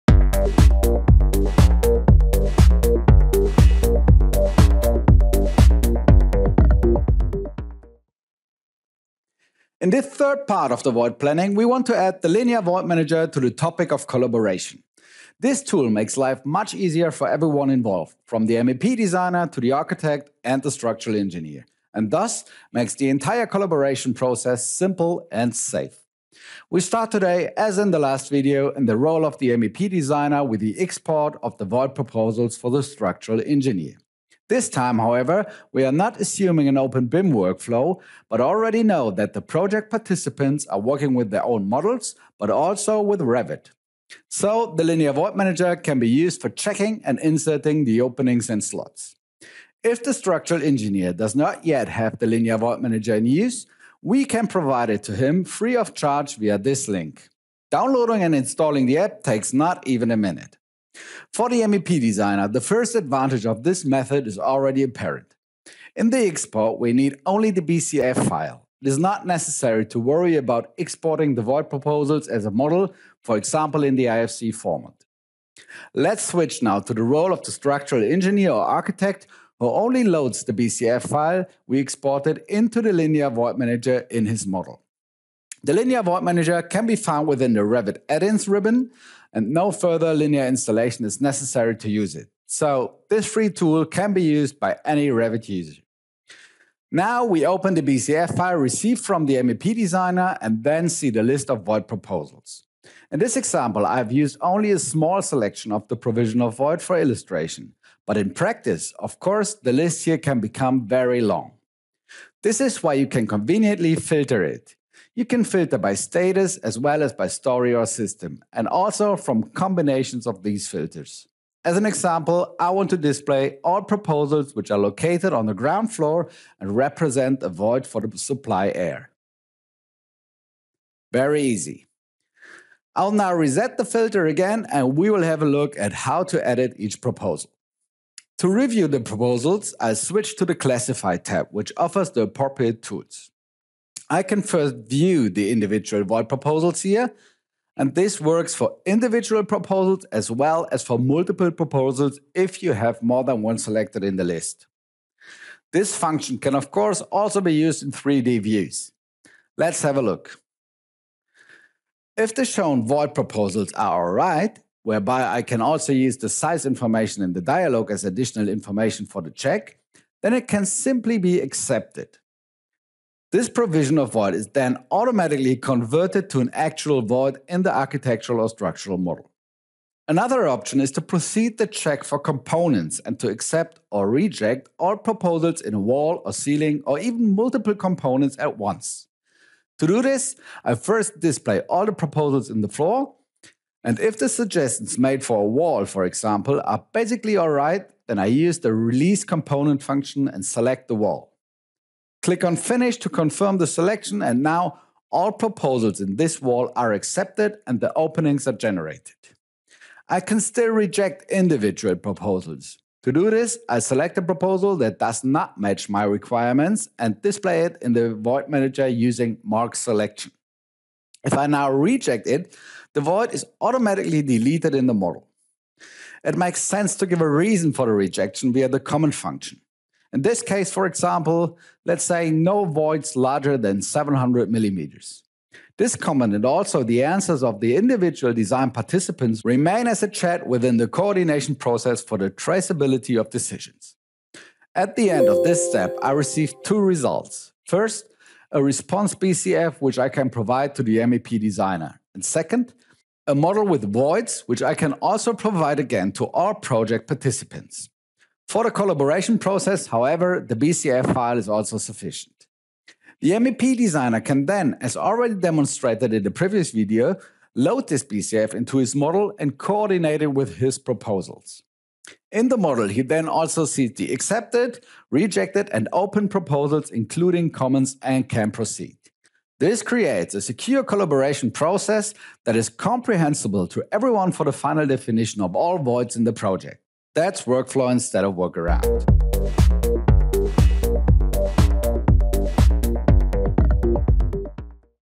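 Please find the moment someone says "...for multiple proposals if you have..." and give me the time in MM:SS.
02:30.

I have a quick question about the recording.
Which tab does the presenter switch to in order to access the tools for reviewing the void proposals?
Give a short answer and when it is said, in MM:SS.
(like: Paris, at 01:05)
Classify, at 02:20.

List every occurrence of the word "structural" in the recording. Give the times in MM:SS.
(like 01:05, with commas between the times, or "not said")
00:20, 00:32, 00:50, 01:17, 02:58.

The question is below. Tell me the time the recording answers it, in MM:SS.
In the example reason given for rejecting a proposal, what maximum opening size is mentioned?
03:53.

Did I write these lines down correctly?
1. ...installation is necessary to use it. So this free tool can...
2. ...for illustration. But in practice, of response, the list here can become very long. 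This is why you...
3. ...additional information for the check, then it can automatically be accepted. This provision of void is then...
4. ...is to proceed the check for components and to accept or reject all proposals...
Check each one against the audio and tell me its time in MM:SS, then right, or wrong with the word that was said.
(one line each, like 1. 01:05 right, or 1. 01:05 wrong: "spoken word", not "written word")
1. 01:30 right
2. 01:46 wrong: "course", not "response"
3. 02:48 wrong: "simply", not "automatically"
4. 03:00 right.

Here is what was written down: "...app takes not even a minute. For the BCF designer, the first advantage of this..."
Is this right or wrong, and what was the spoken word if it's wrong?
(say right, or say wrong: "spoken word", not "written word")
wrong: "MEP", not "BCF".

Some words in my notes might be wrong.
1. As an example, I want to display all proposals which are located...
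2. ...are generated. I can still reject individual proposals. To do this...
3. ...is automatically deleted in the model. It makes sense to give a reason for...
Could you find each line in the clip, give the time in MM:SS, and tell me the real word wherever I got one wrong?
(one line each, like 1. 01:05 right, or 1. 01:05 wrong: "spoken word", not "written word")
1. 02:01 right
2. 03:28 right
3. 03:43 right.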